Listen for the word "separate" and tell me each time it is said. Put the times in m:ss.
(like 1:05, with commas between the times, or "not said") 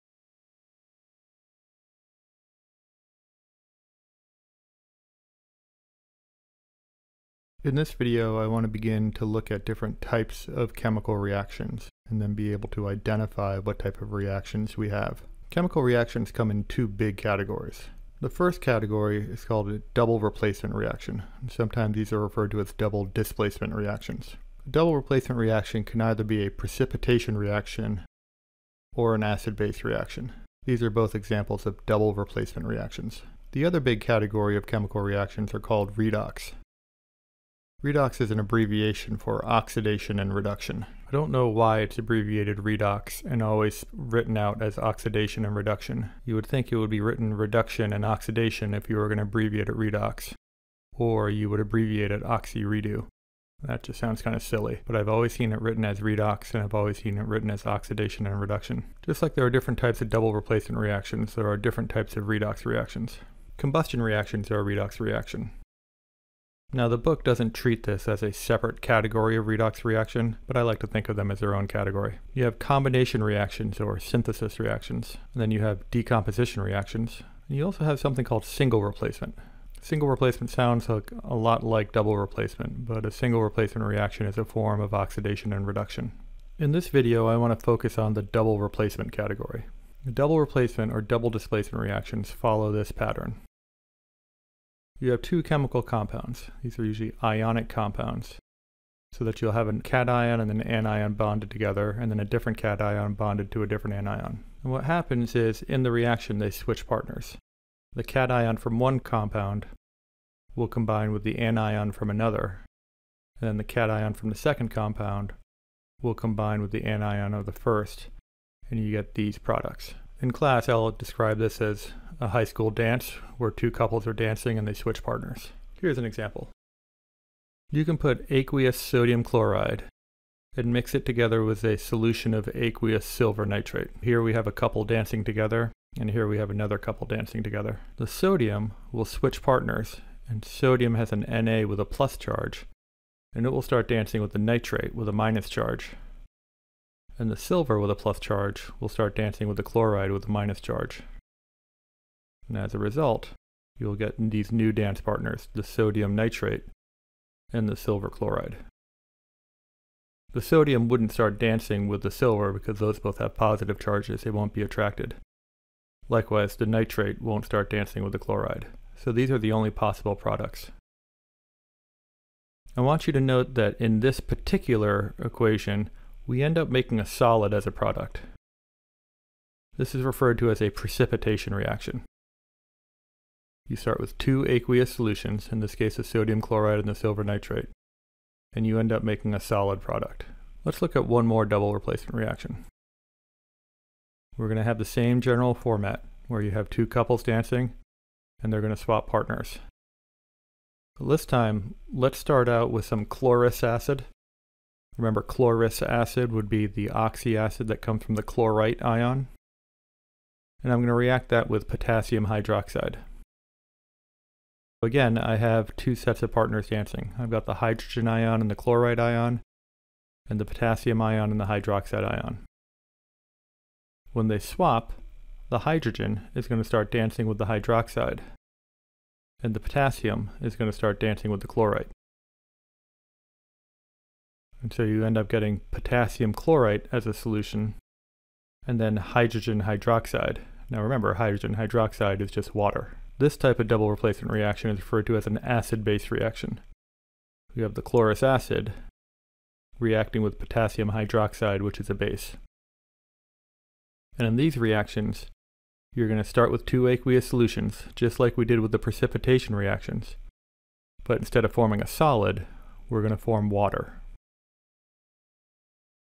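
1:08.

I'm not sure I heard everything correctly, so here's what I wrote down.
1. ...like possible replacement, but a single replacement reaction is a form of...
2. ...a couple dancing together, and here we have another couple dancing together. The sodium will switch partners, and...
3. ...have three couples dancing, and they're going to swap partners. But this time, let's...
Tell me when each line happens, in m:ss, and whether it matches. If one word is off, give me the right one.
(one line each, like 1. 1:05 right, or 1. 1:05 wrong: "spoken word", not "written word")
1. 1:21 wrong: "double", not "possible"
2. 2:14 right
3. 3:16 wrong: "two", not "three".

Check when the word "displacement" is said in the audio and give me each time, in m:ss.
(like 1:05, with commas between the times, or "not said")
0:23, 1:31.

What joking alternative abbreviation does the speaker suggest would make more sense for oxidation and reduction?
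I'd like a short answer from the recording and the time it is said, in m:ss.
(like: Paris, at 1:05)
oxy-redo, at 0:52.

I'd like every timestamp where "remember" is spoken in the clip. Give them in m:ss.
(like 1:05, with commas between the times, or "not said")
3:24, 4:00.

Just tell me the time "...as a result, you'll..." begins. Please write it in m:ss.
2:32.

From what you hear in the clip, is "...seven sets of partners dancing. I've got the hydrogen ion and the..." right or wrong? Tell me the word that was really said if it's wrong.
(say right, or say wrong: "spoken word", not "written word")
wrong: "two", not "seven".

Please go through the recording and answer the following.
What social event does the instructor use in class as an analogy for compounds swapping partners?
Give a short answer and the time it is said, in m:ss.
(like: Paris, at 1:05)
a high school dance, at 2:02.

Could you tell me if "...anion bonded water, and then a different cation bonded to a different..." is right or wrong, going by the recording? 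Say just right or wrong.
wrong.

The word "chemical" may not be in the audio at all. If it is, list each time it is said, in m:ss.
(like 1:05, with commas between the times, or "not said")
0:10, 0:15, 0:34, 1:35.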